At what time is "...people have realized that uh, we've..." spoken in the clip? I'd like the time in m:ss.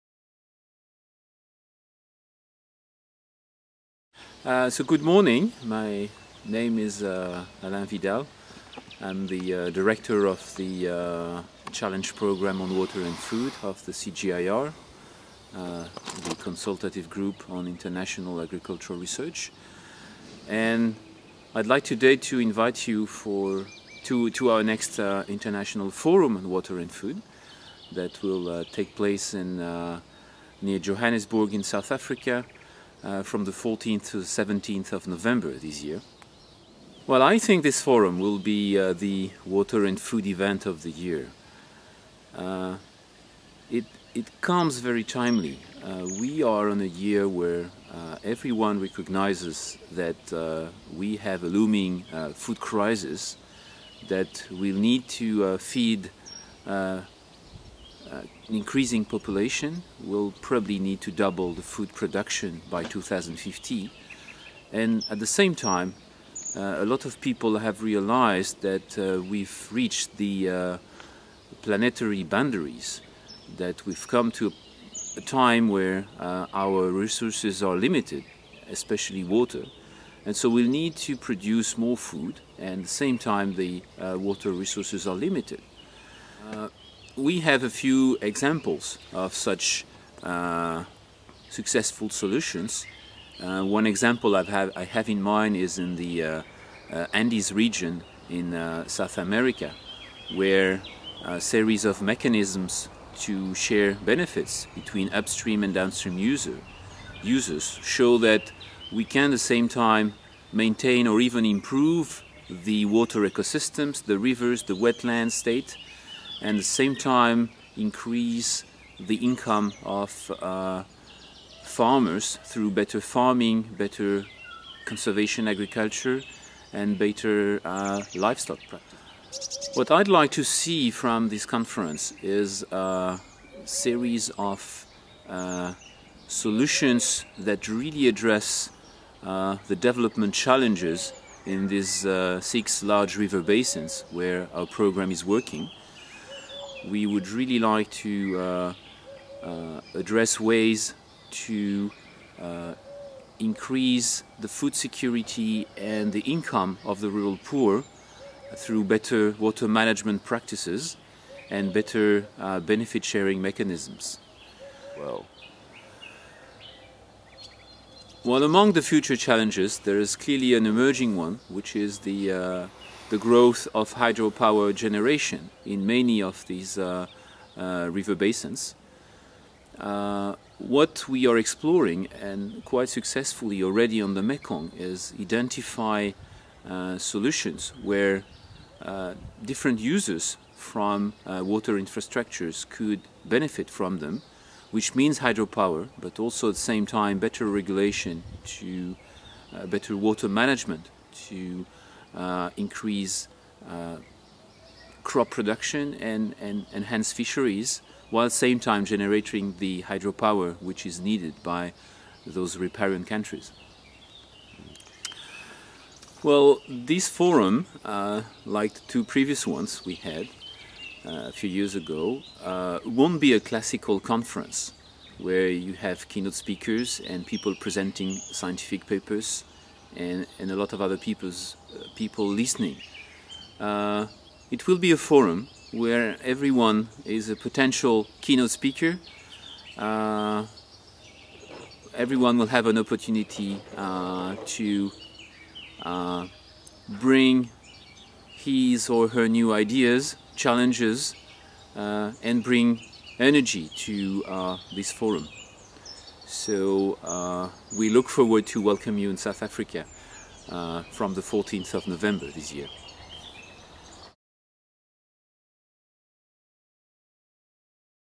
1:07.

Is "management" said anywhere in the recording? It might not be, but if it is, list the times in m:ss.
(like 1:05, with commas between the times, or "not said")
2:39, 3:20.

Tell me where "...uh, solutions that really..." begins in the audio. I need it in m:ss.
2:15.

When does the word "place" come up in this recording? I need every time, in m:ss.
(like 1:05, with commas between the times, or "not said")
0:28.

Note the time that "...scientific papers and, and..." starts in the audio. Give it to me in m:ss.
3:48.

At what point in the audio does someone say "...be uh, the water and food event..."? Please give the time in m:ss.
0:38.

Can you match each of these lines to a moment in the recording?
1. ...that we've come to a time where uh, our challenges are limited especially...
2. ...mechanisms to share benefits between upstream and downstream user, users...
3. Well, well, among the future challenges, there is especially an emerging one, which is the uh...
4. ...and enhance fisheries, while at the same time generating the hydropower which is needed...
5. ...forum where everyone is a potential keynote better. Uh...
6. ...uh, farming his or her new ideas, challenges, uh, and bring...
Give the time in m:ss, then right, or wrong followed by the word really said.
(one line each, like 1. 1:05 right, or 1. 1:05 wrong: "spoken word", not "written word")
1. 1:13 wrong: "resources", not "challenges"
2. 1:42 right
3. 2:44 wrong: "clearly", not "especially"
4. 3:26 right
5. 3:54 wrong: "speaker", not "better"
6. 4:05 wrong: "bring", not "farming".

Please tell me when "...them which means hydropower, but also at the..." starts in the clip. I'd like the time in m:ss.
3:13.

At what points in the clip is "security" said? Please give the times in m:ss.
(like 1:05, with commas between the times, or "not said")
2:34.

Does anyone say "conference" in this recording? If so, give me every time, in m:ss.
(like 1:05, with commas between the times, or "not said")
2:11, 3:44.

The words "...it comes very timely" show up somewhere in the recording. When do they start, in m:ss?
0:44.